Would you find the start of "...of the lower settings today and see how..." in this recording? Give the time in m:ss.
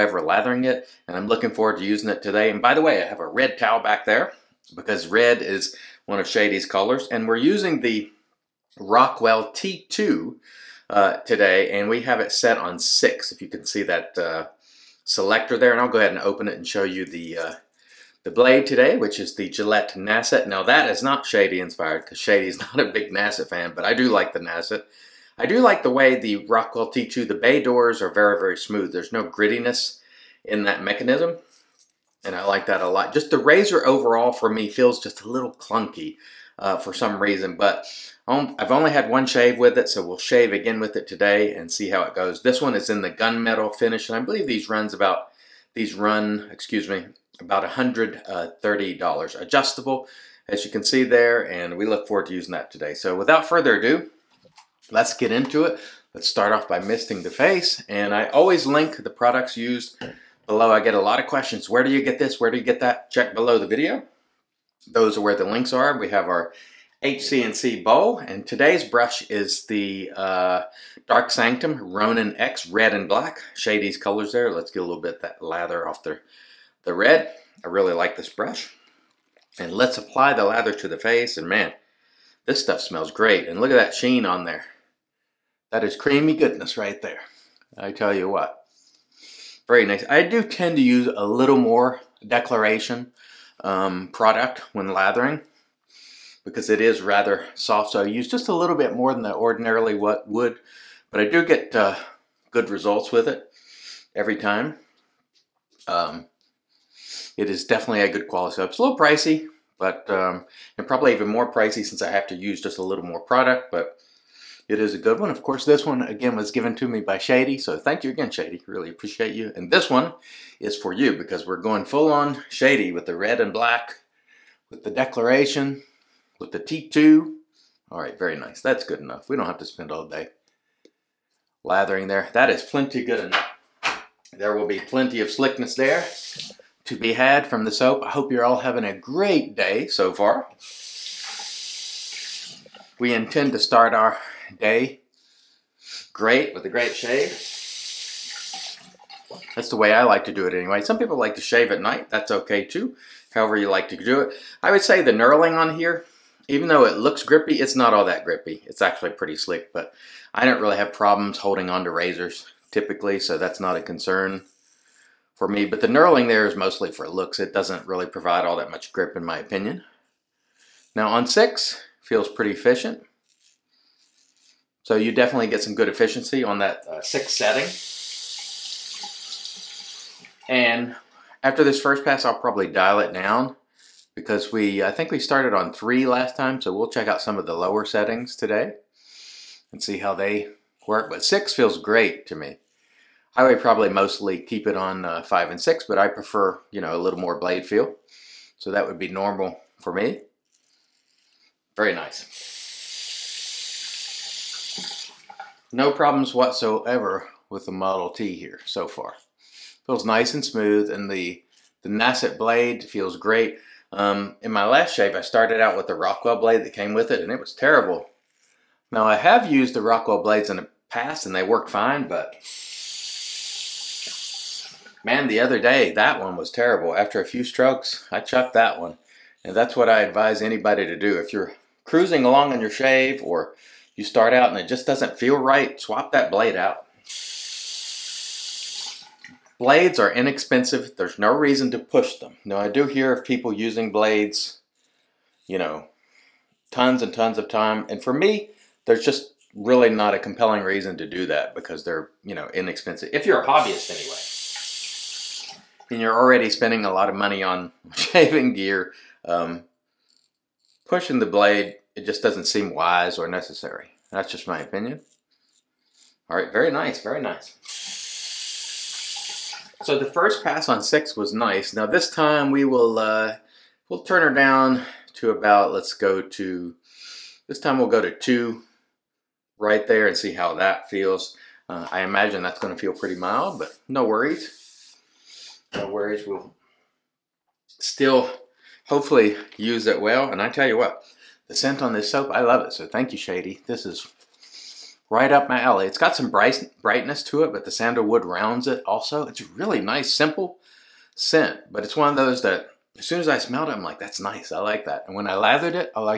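3:07.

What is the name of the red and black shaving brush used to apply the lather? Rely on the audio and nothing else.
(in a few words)
Dark Sanctum Ronin X.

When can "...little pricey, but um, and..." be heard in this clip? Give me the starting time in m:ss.
1:48.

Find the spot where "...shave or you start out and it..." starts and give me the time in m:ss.
3:52.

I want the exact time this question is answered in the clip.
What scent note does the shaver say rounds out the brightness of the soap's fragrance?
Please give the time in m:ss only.
4:57.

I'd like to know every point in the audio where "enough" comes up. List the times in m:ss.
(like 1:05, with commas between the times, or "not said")
2:08, 2:13.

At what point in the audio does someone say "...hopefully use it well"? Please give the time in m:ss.
4:48.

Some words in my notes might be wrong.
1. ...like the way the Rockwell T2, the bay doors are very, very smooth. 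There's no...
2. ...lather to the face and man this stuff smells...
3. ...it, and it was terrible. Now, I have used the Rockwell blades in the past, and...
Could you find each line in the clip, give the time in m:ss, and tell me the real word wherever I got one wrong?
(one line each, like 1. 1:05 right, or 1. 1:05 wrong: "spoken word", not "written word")
1. 0:25 right
2. 1:20 right
3. 3:37 right.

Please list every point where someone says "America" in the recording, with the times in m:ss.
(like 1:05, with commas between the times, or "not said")
not said.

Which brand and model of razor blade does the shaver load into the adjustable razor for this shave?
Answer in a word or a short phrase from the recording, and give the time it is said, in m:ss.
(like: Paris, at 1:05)
Gillette Nacet, at 0:19.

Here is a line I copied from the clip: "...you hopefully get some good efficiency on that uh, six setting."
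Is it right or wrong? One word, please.
wrong.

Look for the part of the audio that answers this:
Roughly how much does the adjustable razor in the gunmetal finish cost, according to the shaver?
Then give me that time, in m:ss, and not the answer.
0:47.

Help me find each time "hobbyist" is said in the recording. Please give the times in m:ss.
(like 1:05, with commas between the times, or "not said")
4:13.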